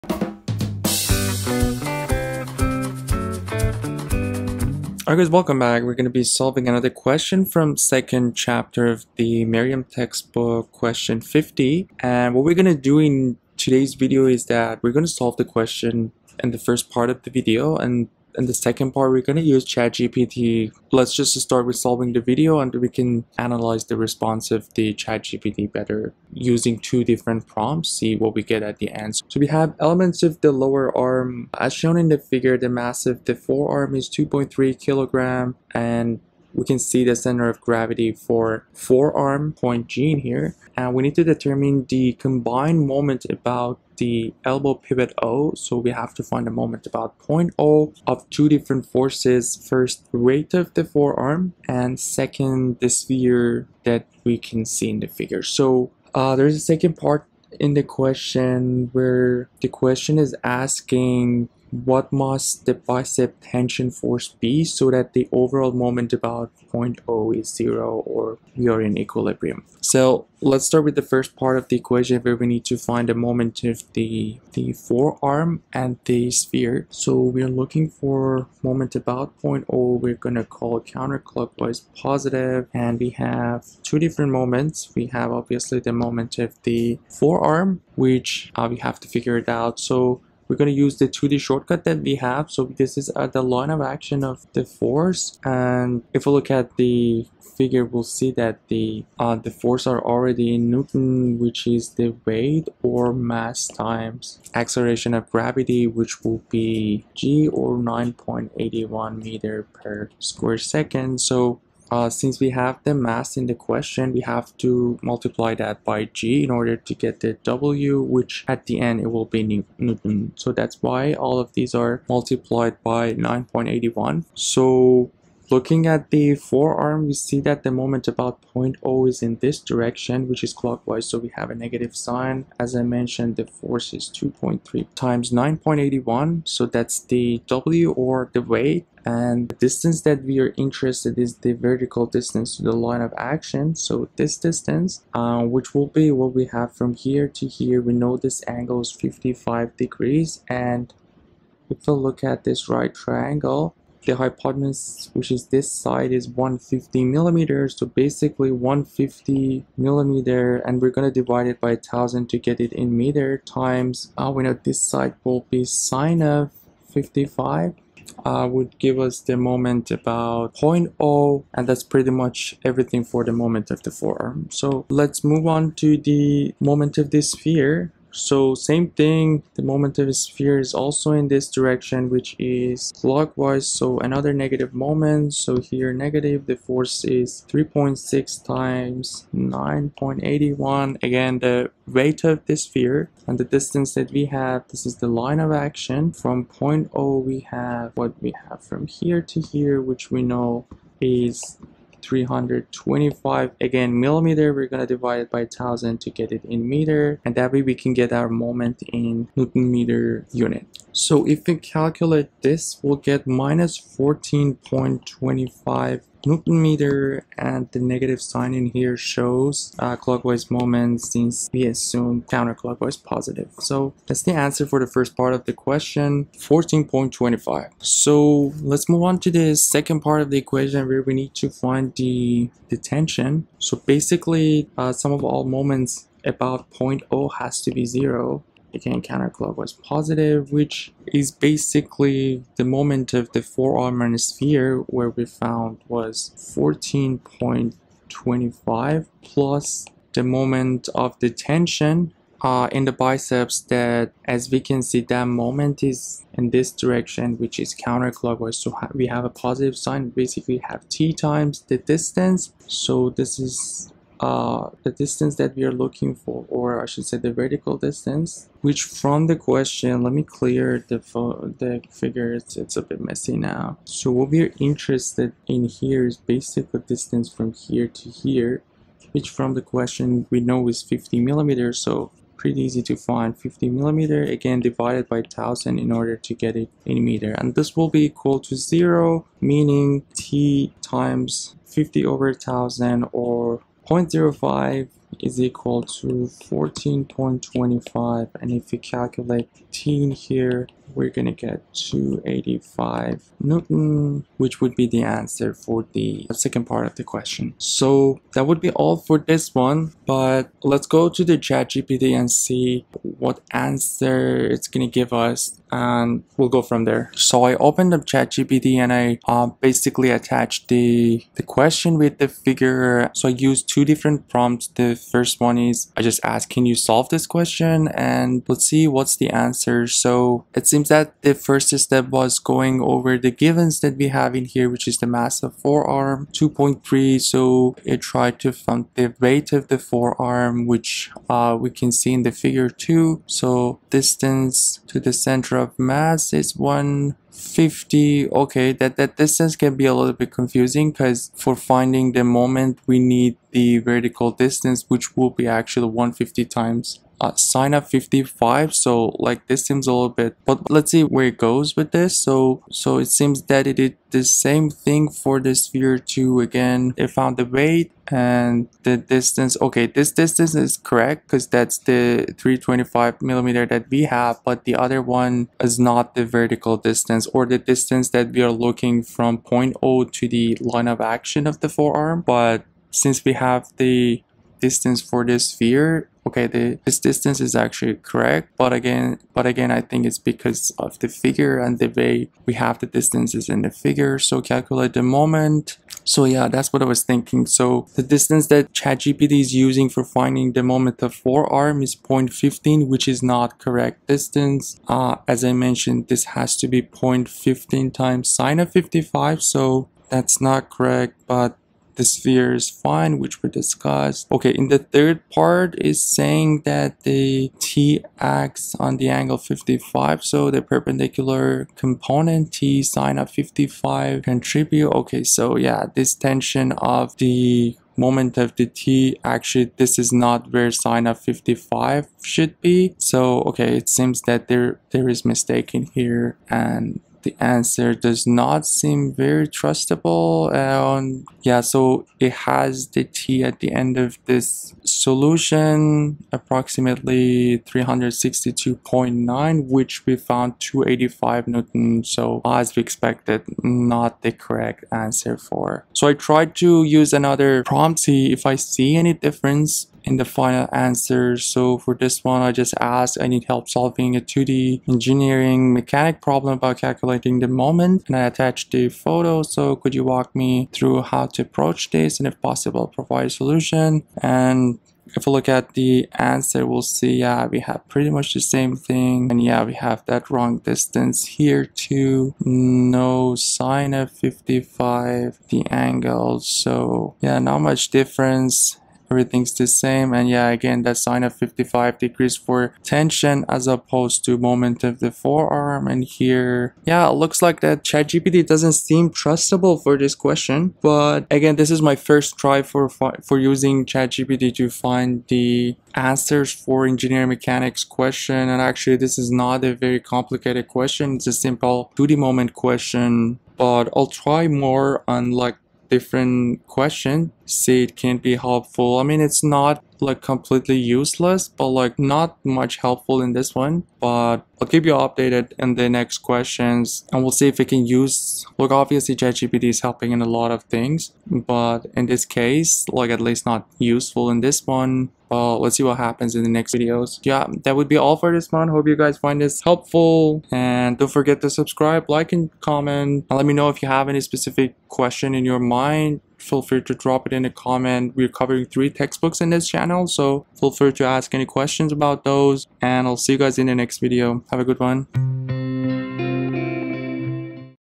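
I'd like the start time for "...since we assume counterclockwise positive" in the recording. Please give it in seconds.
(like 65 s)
221 s.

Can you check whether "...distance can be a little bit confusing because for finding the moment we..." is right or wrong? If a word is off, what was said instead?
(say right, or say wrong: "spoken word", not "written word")
right.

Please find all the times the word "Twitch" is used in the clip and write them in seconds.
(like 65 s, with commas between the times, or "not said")
not said.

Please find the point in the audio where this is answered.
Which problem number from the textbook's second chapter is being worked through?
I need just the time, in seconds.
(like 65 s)
10 s.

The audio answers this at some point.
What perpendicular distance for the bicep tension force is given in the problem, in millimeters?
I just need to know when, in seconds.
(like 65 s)
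280 s.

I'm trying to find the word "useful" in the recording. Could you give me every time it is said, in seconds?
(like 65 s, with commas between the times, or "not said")
533 s.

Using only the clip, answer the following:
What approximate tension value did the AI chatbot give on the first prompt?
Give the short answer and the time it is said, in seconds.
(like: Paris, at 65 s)
362.9, at 447 s.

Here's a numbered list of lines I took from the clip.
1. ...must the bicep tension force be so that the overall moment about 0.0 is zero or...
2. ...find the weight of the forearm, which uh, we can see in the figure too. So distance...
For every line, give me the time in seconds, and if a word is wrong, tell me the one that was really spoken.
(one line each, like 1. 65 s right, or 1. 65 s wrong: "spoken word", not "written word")
1. 62 s right
2. 338 s right.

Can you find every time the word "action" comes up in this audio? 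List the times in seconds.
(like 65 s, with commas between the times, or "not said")
93 s, 143 s, 195 s, 381 s.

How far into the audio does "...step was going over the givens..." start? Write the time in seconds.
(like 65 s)
331 s.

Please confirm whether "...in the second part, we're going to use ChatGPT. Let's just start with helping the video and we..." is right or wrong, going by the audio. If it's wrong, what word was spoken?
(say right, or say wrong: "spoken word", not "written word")
wrong: "solving", not "helping".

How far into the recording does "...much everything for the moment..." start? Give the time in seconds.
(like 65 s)
172 s.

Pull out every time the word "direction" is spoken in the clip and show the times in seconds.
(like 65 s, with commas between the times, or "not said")
129 s, 181 s, 256 s.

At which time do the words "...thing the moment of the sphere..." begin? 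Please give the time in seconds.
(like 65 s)
178 s.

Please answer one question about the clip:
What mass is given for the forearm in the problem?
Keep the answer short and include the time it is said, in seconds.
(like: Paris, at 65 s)
2.3 kilograms, at 34 s.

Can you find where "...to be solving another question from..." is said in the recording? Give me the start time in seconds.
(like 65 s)
6 s.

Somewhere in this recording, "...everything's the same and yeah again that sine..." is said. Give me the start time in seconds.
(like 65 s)
489 s.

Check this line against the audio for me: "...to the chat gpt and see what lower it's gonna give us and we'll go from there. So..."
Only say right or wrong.
wrong.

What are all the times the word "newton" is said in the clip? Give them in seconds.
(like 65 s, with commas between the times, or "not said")
100 s, 119 s, 209 s, 216 s, 303 s, 451 s.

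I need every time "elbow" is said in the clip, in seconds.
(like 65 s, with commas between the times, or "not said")
44 s.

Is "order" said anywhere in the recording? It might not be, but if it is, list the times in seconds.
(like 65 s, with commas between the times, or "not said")
116 s, 285 s.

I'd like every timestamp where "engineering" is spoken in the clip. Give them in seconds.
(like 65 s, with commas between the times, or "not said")
464 s, 506 s.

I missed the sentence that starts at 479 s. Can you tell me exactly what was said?
And yeah, we have that wrong distance here too.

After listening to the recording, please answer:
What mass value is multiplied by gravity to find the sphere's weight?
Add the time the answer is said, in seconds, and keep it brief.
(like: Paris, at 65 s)
3.6, at 187 s.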